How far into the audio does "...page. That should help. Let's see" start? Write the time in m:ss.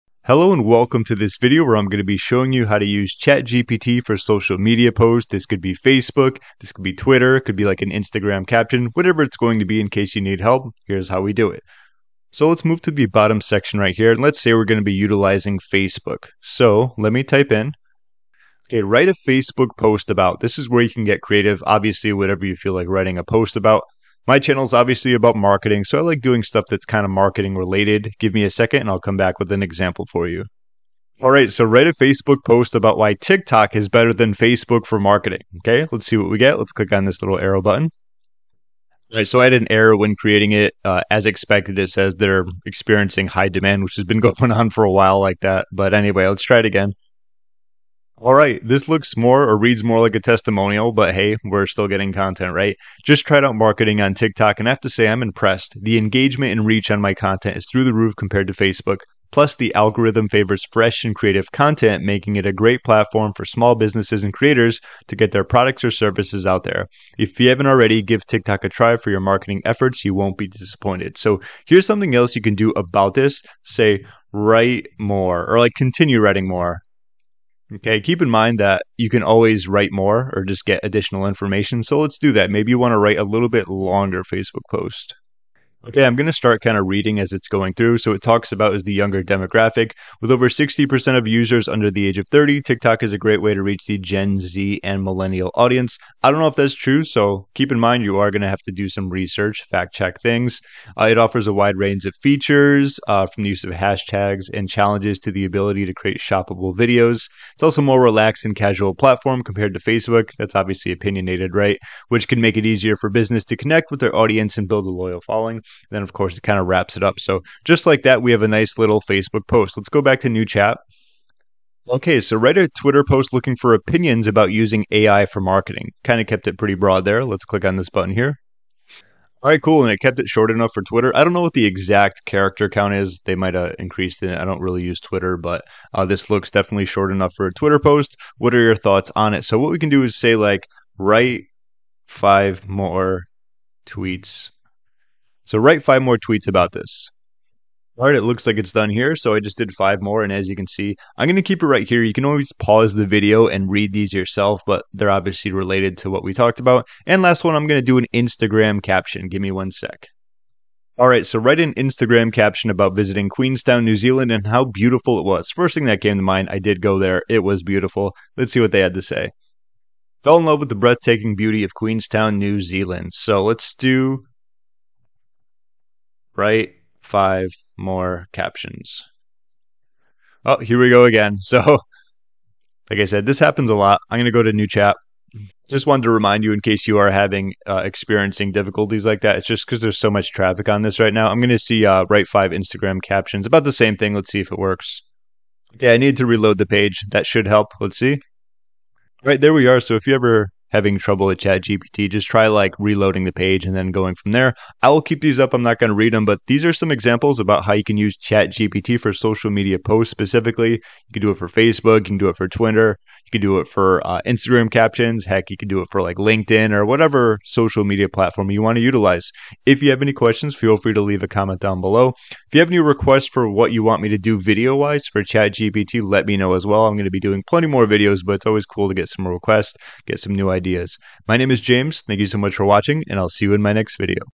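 3:16.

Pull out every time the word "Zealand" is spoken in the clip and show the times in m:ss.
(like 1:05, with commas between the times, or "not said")
2:43, 2:52.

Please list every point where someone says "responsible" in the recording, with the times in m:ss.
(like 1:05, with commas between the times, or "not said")
not said.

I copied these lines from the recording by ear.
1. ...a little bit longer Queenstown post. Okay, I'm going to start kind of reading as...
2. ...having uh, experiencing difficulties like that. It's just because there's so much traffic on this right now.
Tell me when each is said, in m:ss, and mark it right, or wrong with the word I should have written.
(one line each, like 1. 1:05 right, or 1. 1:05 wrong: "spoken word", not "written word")
1. 1:23 wrong: "Facebook", not "Queenstown"
2. 3:07 right.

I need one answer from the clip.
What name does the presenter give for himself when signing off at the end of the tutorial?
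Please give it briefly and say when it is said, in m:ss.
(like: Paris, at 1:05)
James, at 3:51.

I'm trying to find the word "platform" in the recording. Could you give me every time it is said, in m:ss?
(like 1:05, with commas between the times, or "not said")
1:02, 1:48, 3:38.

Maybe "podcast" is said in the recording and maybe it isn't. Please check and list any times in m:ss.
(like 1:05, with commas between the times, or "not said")
not said.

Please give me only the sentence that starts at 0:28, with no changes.
Give me a second and I'll come back with an example for you.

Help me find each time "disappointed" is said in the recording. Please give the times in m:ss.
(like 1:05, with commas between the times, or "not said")
1:10.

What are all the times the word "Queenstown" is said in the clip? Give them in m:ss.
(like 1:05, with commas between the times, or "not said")
2:43, 2:51.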